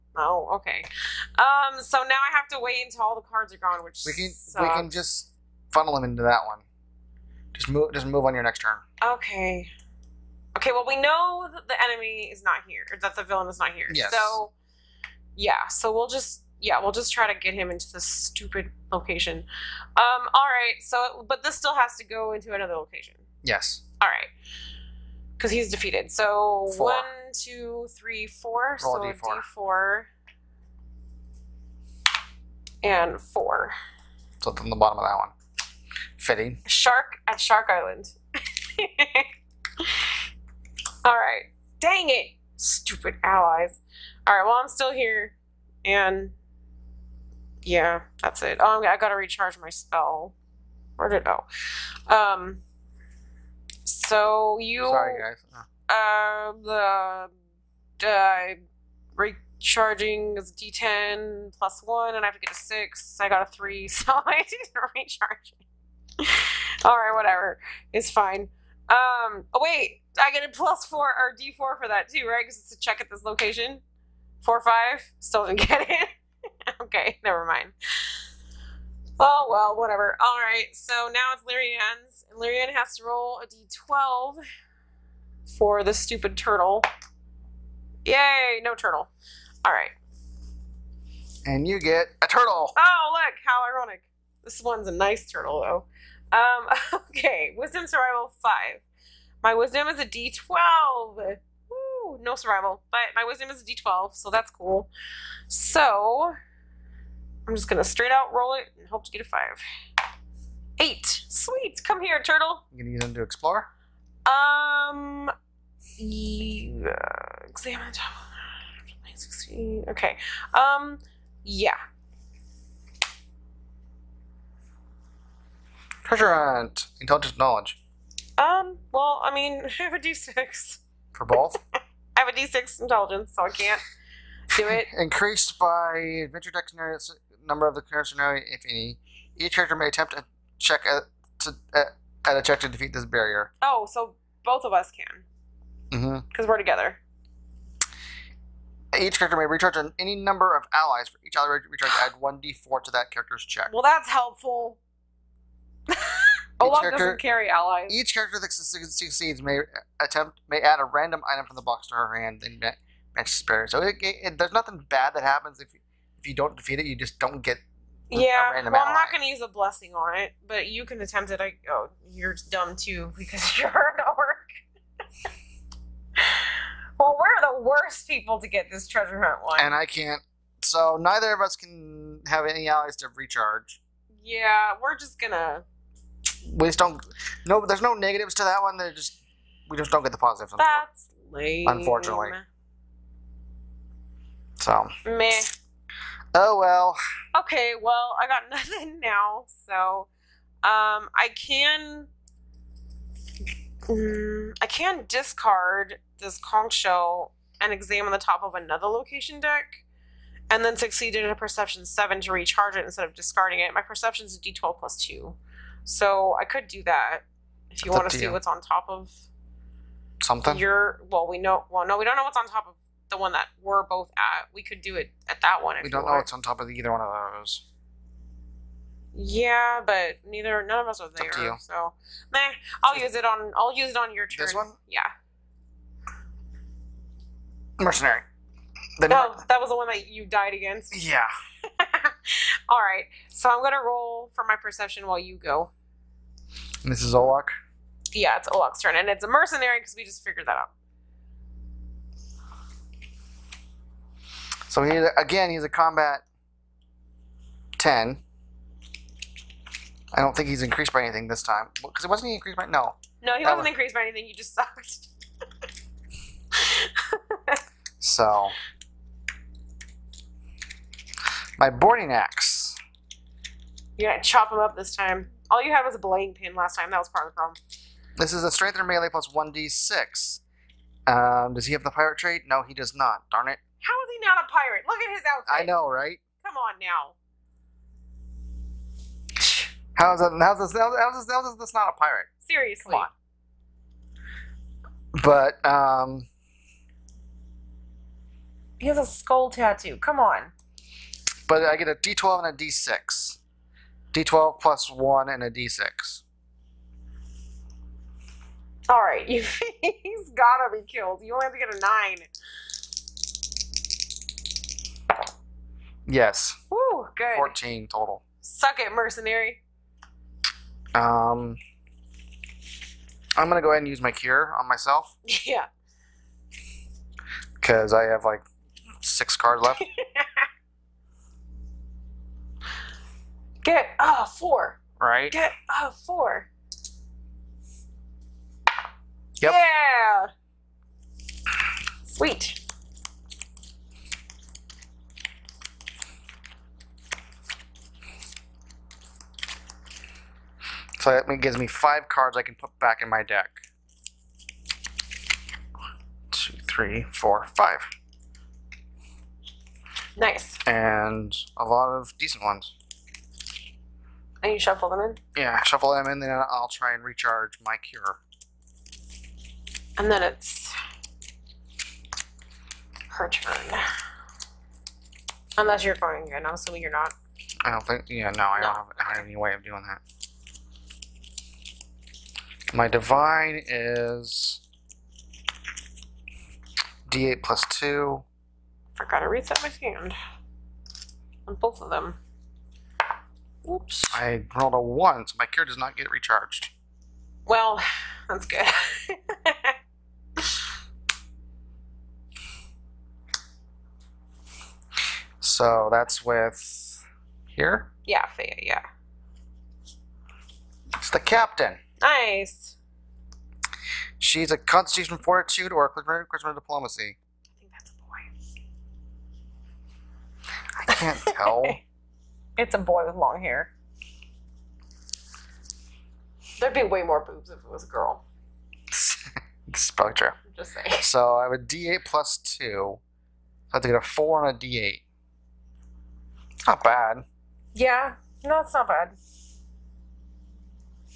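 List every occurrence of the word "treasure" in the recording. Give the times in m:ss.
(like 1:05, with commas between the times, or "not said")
2:06, 2:58.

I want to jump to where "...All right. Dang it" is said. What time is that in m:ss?
0:41.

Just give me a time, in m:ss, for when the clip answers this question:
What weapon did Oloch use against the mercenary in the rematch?
4:31.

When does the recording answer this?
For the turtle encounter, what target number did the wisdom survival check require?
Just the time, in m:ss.
1:37.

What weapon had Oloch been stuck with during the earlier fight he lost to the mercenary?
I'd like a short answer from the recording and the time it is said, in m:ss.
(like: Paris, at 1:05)
belaying pin, at 4:35.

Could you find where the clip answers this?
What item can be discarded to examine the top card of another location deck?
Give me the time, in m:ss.
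3:26.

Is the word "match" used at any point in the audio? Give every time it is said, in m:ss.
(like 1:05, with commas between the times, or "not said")
2:43.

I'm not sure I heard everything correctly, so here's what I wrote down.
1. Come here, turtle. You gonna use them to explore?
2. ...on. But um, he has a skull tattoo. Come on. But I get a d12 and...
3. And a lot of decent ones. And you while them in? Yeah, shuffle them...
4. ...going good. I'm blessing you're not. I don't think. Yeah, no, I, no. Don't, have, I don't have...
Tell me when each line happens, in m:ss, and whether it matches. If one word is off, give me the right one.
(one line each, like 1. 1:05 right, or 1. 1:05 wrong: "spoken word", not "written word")
1. 1:51 right
2. 4:55 right
3. 6:00 wrong: "shuffle", not "while"
4. 6:15 wrong: "assuming", not "blessing".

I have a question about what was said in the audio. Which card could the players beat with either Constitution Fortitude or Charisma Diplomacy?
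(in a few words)
the captain.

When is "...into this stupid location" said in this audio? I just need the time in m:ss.
0:17.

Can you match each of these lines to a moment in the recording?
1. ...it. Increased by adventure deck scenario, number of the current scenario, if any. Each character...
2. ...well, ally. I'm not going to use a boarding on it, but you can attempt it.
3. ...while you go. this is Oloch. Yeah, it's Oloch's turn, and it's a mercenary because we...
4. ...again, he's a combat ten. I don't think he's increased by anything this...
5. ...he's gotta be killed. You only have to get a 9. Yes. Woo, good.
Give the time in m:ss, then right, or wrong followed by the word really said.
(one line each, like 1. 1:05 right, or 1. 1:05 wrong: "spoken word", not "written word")
1. 2:14 right
2. 2:48 wrong: "blessing", not "boarding"
3. 4:05 right
4. 4:15 right
5. 5:09 right.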